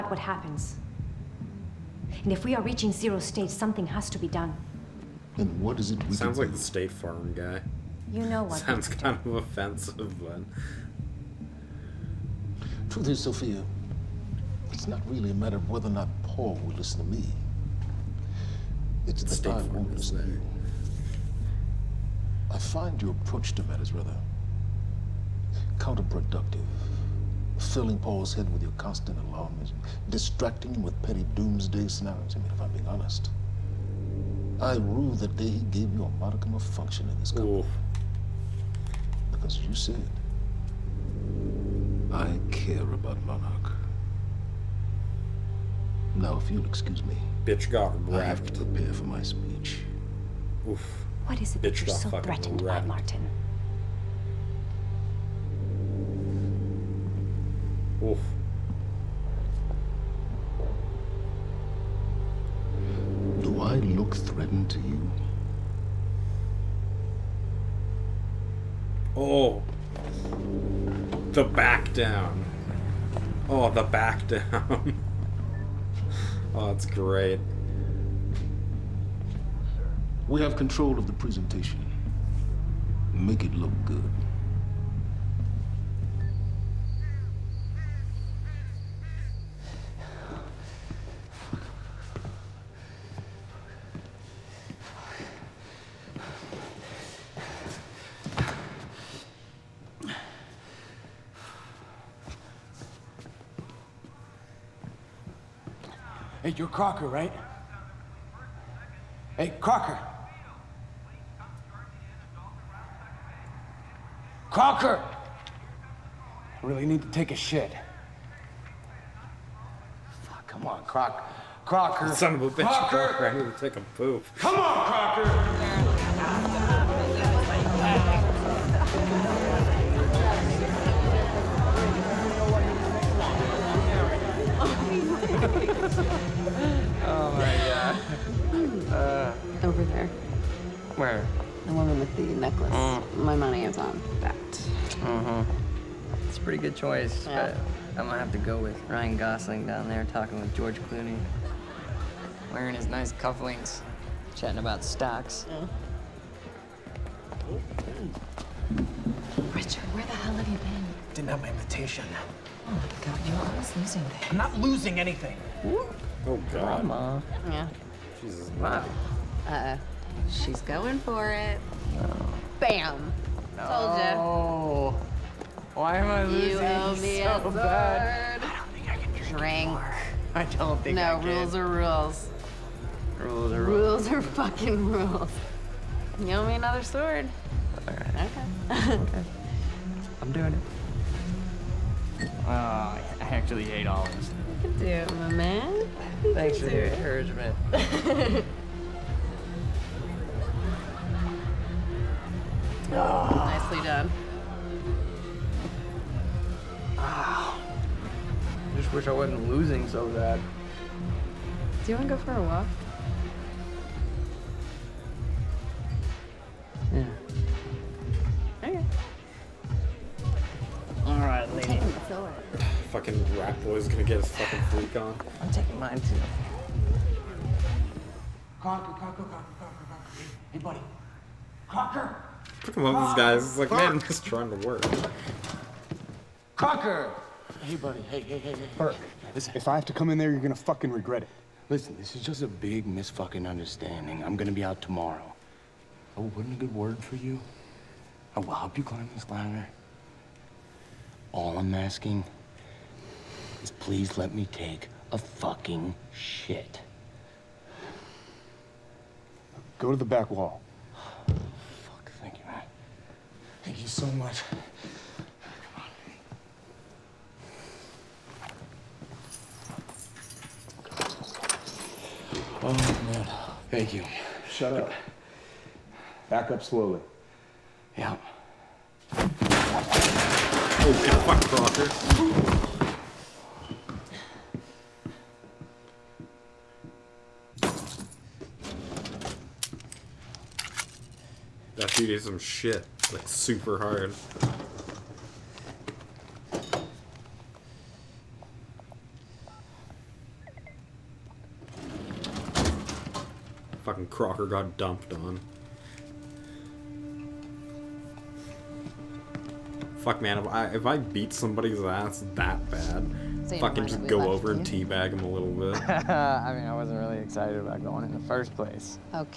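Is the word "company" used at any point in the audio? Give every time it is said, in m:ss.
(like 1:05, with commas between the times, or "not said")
0:37.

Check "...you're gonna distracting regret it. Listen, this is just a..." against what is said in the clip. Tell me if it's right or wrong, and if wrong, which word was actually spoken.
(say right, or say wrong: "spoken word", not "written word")
wrong: "fucking", not "distracting".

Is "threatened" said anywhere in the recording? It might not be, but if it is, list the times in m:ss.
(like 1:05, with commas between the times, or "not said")
0:52, 1:04.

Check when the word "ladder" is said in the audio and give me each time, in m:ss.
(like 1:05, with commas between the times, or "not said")
4:09.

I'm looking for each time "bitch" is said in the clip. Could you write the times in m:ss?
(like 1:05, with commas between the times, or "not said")
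0:47, 0:51, 2:02.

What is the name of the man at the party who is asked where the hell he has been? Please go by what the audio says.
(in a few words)
Richard.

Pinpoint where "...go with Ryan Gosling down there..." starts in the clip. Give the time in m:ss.
2:28.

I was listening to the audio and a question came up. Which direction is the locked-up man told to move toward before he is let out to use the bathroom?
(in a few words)
back wall.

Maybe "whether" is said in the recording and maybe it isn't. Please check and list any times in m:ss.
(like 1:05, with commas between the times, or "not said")
0:15.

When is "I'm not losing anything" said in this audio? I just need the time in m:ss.
2:44.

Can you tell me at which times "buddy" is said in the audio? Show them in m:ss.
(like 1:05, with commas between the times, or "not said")
3:50, 3:57.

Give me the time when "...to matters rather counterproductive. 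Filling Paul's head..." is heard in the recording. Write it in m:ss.
0:23.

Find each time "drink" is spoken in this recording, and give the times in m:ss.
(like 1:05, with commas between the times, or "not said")
2:59.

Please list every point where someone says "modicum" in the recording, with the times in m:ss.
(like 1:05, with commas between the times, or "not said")
0:36.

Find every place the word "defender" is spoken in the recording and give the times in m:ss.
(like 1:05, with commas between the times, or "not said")
not said.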